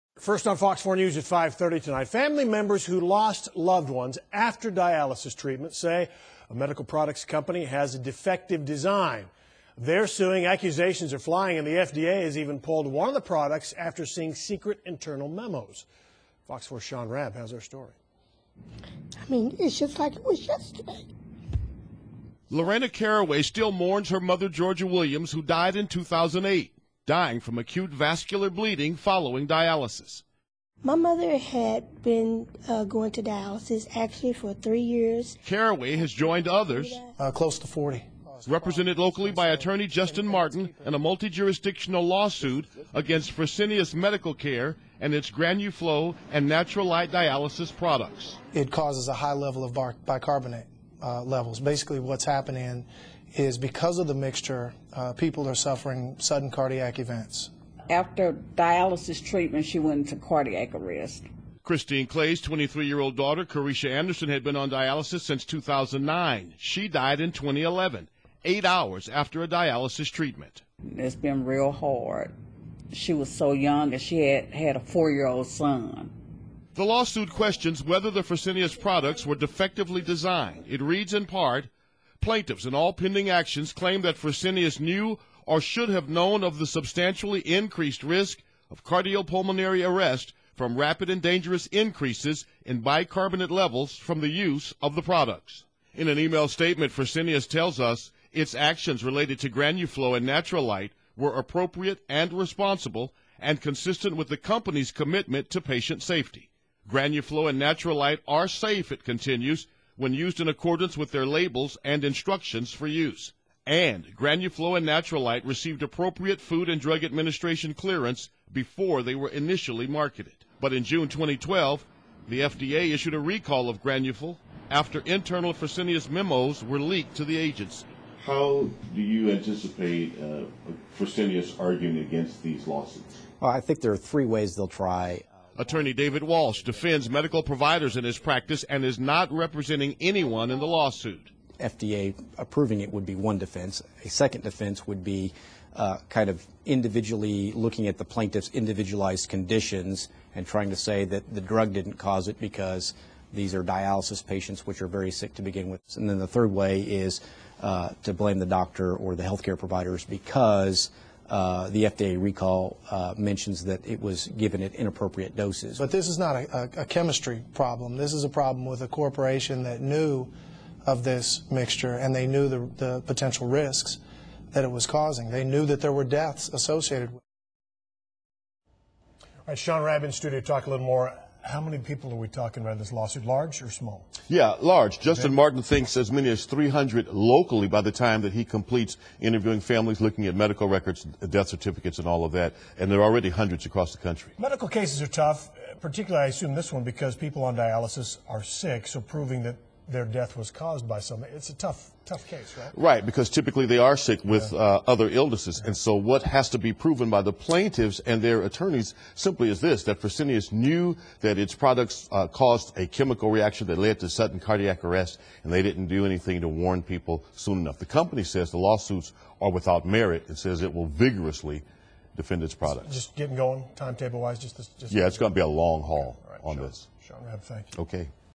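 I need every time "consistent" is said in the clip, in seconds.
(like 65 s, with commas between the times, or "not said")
103 s.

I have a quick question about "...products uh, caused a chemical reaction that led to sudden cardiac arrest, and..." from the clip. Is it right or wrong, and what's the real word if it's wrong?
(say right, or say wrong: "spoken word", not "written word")
right.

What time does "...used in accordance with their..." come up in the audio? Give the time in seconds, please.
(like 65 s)
110 s.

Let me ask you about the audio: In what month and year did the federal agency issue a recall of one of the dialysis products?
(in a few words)
June 2012.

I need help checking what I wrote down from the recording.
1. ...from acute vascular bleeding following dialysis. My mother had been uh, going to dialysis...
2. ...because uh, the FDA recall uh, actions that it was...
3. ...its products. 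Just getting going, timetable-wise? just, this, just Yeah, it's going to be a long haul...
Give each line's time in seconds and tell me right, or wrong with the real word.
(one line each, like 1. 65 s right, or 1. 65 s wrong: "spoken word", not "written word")
1. 27 s right
2. 160 s wrong: "mentions", not "actions"
3. 222 s right.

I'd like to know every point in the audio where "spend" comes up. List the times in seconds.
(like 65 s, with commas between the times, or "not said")
not said.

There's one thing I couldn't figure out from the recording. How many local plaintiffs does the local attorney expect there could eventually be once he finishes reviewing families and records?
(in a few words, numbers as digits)
300.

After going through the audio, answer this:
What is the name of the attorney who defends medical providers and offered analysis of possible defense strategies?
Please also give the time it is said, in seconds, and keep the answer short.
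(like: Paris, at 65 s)
David Walsh, at 135 s.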